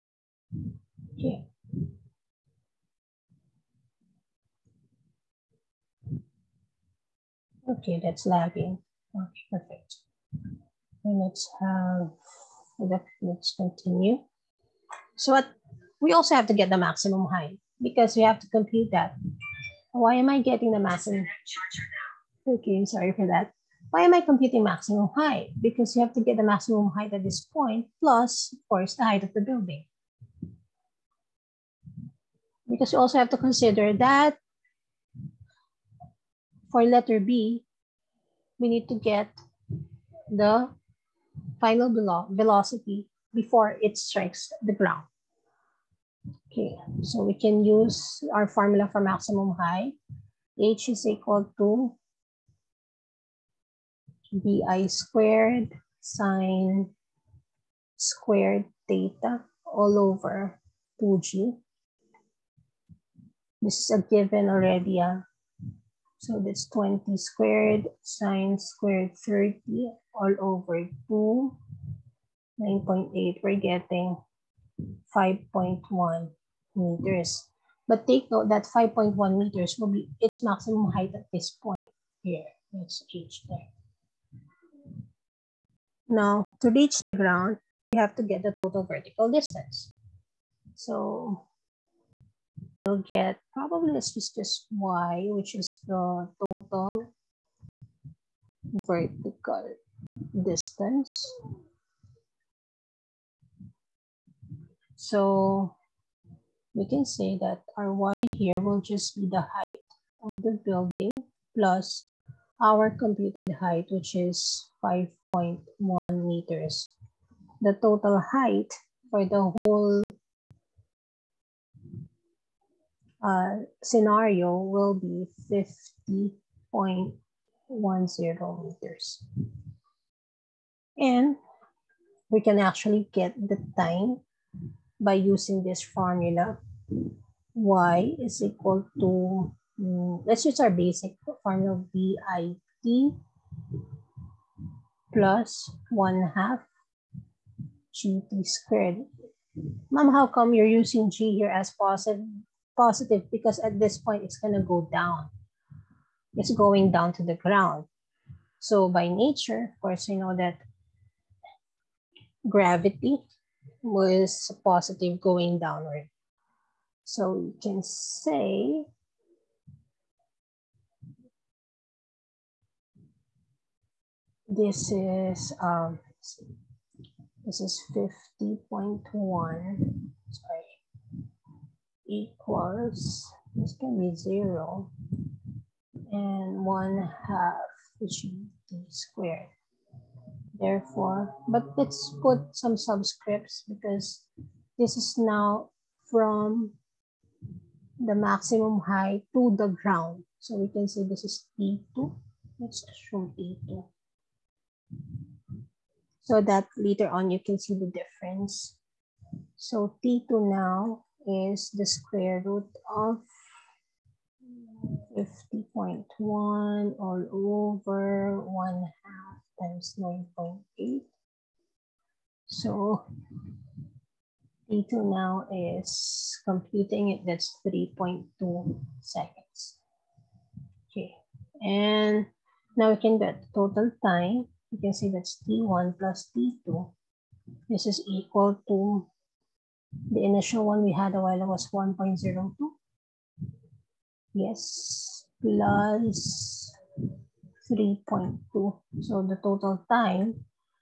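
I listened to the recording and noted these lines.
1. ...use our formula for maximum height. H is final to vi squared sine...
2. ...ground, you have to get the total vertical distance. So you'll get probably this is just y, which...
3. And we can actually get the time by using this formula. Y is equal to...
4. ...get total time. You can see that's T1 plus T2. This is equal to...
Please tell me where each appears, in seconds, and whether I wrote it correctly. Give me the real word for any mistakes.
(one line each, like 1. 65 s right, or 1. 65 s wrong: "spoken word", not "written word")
1. 47 s wrong: "equal", not "final"
2. 87 s right
3. 130 s right
4. 233 s right.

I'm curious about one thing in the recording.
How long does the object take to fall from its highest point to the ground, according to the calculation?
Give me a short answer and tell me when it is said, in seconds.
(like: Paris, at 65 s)
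3.2 seconds, at 227 s.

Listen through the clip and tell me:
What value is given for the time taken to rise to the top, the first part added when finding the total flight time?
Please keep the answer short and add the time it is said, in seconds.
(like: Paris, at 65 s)
1.02, at 241 s.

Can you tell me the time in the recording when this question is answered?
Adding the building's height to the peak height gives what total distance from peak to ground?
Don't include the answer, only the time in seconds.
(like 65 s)
125 s.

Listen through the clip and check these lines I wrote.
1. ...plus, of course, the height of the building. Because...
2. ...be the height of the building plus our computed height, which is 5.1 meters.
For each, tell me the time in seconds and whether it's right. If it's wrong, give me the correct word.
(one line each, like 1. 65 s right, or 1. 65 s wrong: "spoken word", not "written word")
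1. 28 s right
2. 109 s right.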